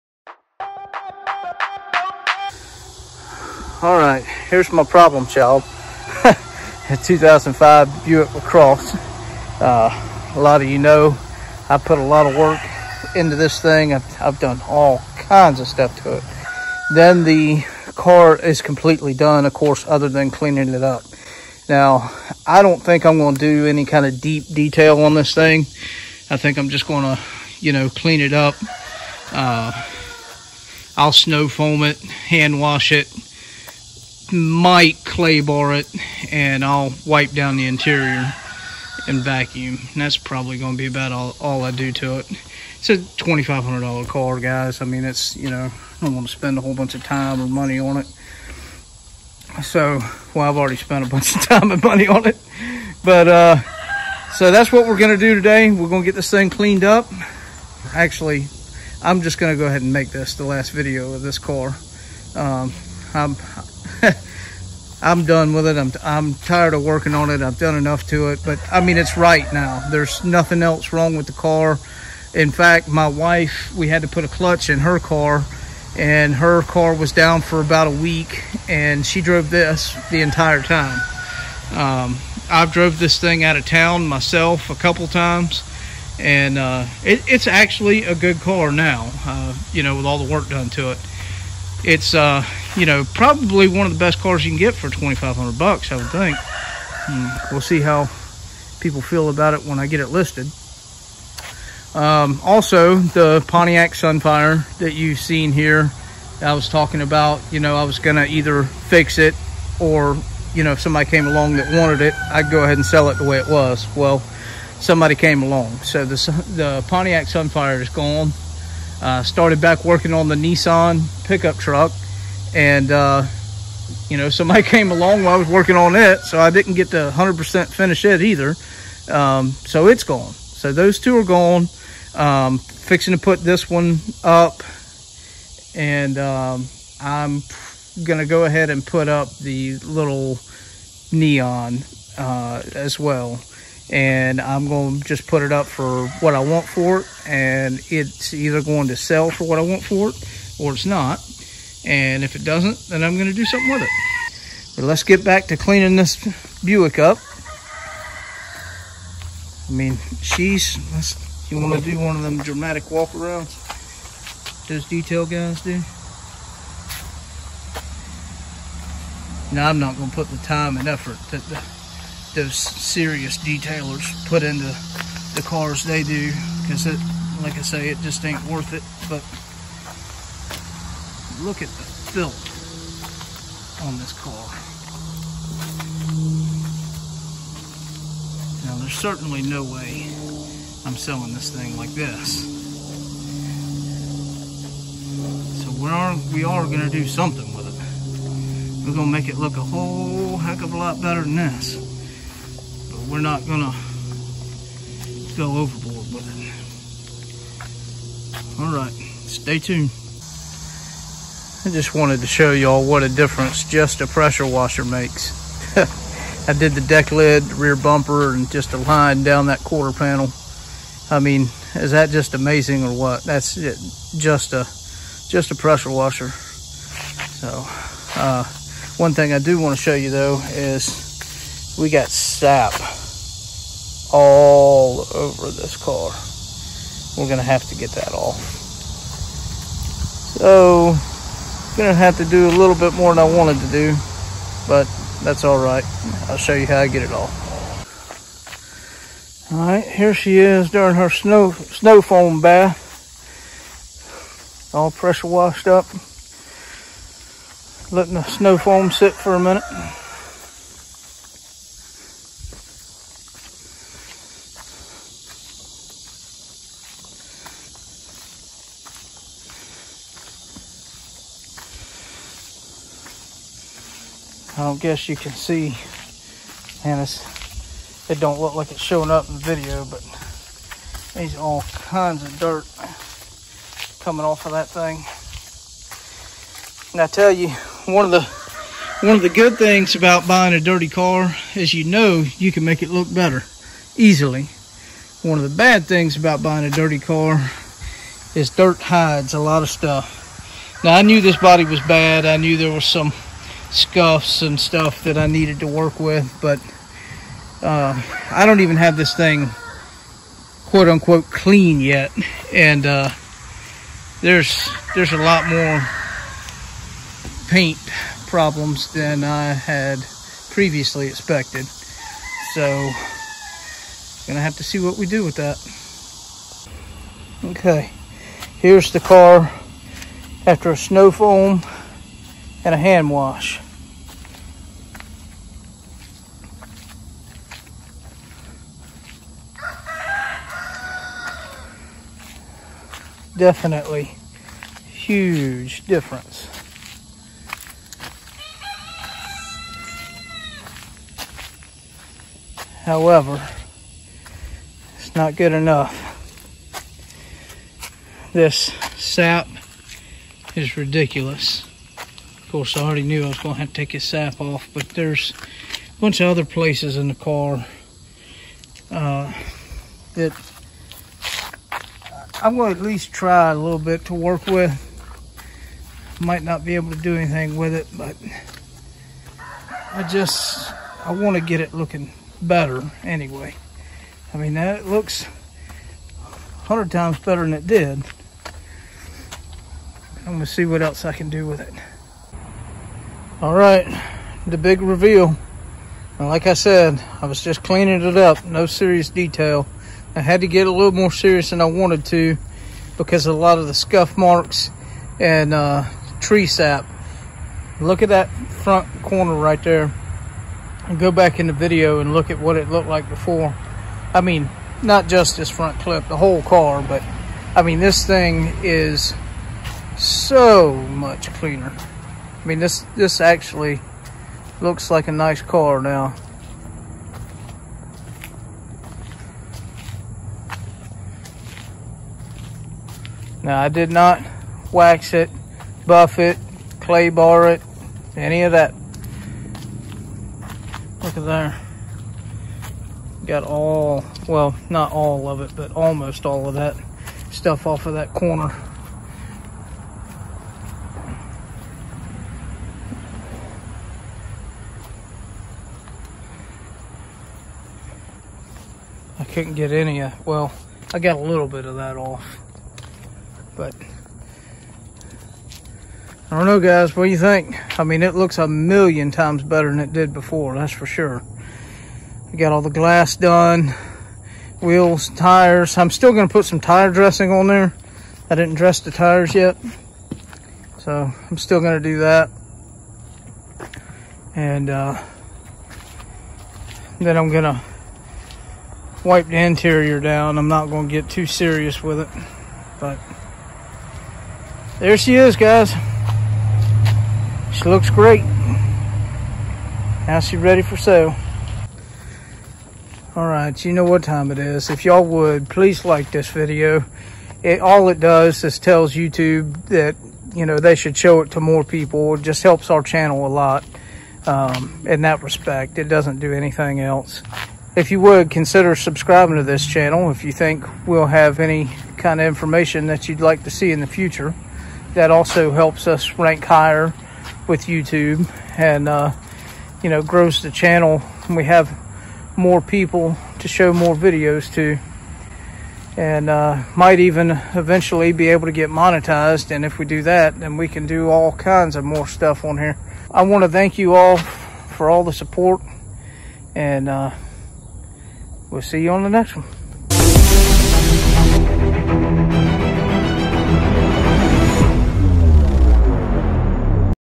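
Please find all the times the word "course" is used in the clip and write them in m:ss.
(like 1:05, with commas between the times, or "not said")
0:19, 6:02.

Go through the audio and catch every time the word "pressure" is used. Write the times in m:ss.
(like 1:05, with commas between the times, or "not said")
3:34, 3:45, 4:14.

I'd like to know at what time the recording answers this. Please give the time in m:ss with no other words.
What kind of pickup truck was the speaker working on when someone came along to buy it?
2:00.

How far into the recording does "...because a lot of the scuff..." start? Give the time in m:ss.
6:42.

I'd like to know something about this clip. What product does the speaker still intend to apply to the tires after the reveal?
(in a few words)
tire dressing.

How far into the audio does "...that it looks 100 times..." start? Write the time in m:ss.
6:24.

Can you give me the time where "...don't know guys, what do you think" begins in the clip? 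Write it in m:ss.
7:46.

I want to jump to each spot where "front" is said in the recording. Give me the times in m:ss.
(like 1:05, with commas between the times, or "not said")
6:48, 6:55.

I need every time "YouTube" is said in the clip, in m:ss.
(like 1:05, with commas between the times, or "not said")
8:28, 8:47.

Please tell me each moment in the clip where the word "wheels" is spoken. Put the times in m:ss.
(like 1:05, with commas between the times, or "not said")
7:54.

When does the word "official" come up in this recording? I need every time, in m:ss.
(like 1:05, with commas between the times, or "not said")
not said.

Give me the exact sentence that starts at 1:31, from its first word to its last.
It's uh, you know, probably one of the best cars you can get for 2500 bucks, I would think.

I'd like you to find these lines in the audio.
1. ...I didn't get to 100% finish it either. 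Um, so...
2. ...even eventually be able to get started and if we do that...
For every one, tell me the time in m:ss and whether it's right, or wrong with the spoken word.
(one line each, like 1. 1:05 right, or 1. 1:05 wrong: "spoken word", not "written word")
1. 2:06 right
2. 8:56 wrong: "monetized", not "started".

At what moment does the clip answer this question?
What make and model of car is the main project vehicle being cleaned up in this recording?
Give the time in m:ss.
0:08.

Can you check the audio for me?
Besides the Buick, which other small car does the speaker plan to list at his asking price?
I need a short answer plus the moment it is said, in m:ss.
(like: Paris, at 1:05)
Neon, at 2:21.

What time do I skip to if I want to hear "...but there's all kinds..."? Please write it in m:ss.
4:39.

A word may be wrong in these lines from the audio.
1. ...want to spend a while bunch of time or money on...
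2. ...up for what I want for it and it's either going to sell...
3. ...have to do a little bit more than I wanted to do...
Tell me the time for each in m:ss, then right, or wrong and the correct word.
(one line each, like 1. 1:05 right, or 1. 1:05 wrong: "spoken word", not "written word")
1. 0:46 wrong: "whole", not "while"
2. 2:25 right
3. 4:01 right.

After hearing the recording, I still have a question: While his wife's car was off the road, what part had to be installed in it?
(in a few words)
clutch.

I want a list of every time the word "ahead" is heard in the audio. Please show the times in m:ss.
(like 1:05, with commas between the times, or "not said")
0:59, 1:52, 2:18.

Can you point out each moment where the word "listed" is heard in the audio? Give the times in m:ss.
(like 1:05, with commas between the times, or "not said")
1:40.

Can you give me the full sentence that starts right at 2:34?
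But let's get back to cleaning this Buick up.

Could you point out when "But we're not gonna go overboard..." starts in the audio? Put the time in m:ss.
3:22.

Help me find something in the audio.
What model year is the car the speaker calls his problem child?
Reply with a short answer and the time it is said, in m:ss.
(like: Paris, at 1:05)
2005, at 0:07.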